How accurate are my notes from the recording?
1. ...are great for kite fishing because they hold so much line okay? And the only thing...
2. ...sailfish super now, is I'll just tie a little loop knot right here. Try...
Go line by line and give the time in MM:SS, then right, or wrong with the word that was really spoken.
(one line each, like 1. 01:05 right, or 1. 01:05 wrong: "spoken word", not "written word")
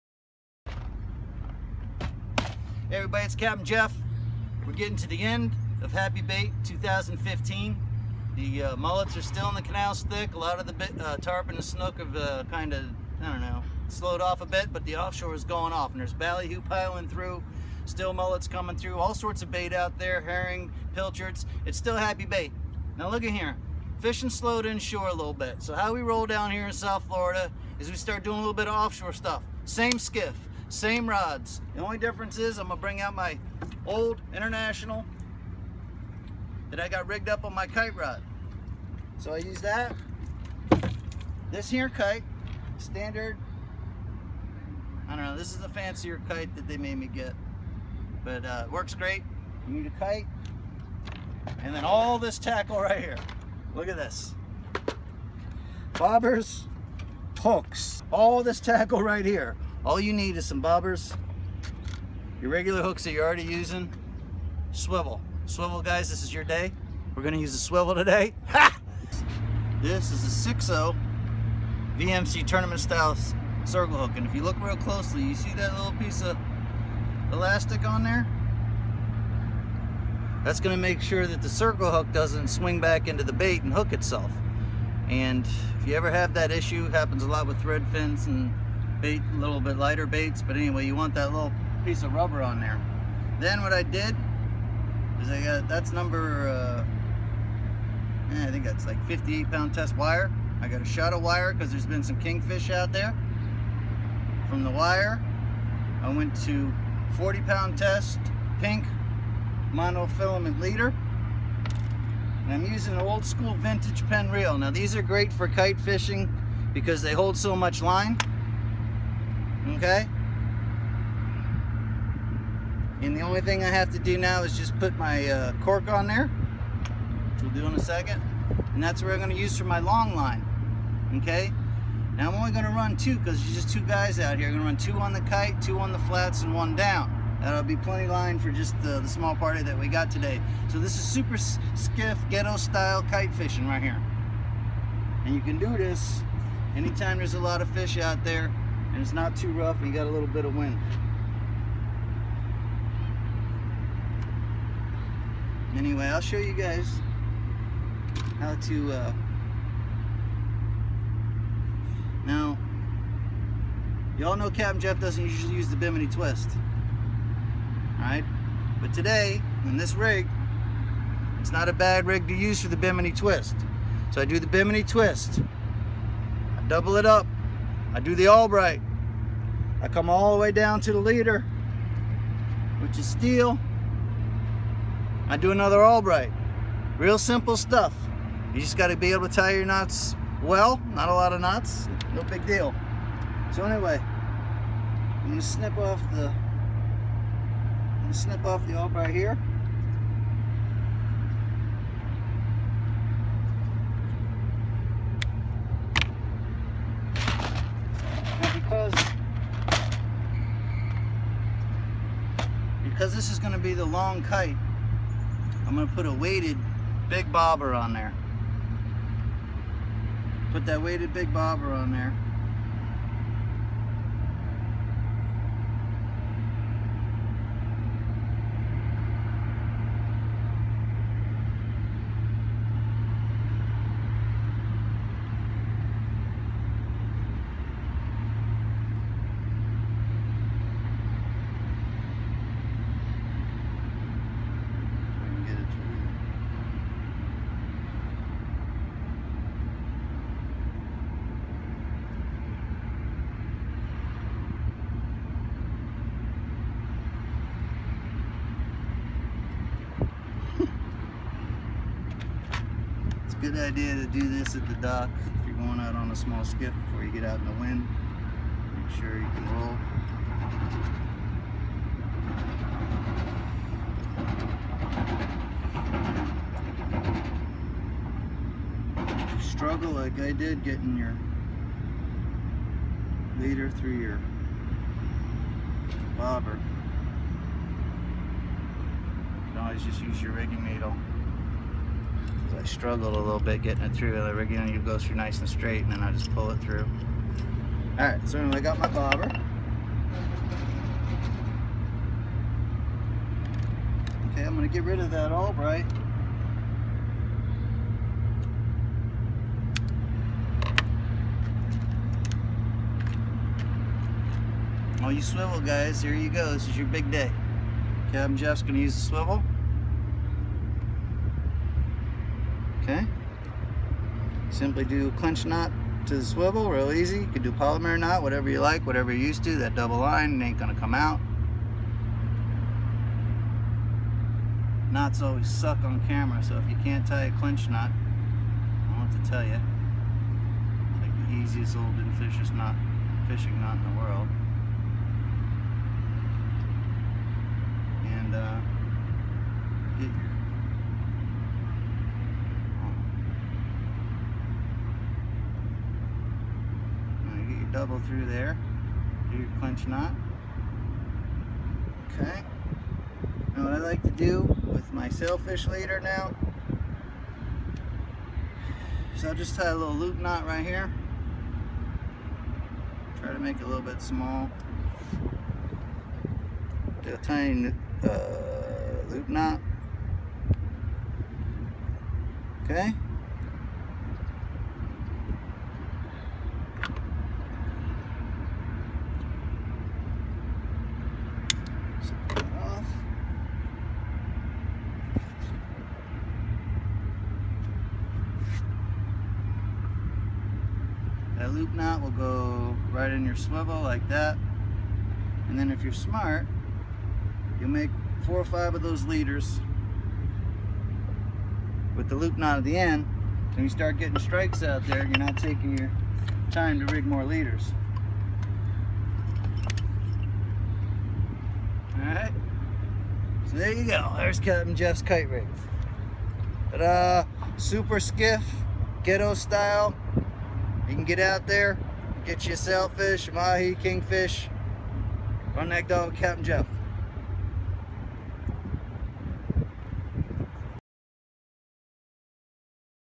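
1. 01:54 right
2. 06:05 wrong: "leader", not "super".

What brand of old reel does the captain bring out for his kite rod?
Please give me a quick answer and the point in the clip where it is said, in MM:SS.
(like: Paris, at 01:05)
International, at 00:34.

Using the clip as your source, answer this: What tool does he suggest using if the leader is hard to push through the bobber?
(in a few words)
Rigging needle.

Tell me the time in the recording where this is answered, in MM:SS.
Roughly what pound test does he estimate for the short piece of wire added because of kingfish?
01:39.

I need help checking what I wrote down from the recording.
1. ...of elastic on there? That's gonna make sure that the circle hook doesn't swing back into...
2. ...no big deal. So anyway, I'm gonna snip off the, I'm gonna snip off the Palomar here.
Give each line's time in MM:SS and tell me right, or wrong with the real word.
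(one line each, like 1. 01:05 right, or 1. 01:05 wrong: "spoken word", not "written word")
1. 01:16 right
2. 03:12 wrong: "Albright", not "Palomar".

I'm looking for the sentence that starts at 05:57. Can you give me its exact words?
through there, do your clinch knot.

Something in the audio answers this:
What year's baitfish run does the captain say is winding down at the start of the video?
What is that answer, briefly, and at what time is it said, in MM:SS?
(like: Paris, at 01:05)
2015, at 00:06.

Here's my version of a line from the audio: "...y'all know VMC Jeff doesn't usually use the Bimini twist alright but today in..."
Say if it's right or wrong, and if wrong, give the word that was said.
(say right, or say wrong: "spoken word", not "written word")
wrong: "Captain", not "VMC".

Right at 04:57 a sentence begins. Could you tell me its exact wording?
Alright, so anyway, I got my bobber.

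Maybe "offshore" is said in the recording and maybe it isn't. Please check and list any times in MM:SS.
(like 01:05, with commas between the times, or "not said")
00:14, 00:28.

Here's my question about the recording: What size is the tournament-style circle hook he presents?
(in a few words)
6.0.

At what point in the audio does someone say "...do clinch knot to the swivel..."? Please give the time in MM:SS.
05:24.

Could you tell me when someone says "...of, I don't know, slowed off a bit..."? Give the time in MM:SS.
00:12.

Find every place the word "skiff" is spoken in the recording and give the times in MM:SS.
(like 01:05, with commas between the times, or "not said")
00:29, 02:21, 04:26, 07:07.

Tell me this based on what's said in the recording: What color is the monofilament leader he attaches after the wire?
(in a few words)
Pink.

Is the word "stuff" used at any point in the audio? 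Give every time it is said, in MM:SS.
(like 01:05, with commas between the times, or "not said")
00:29, 03:07.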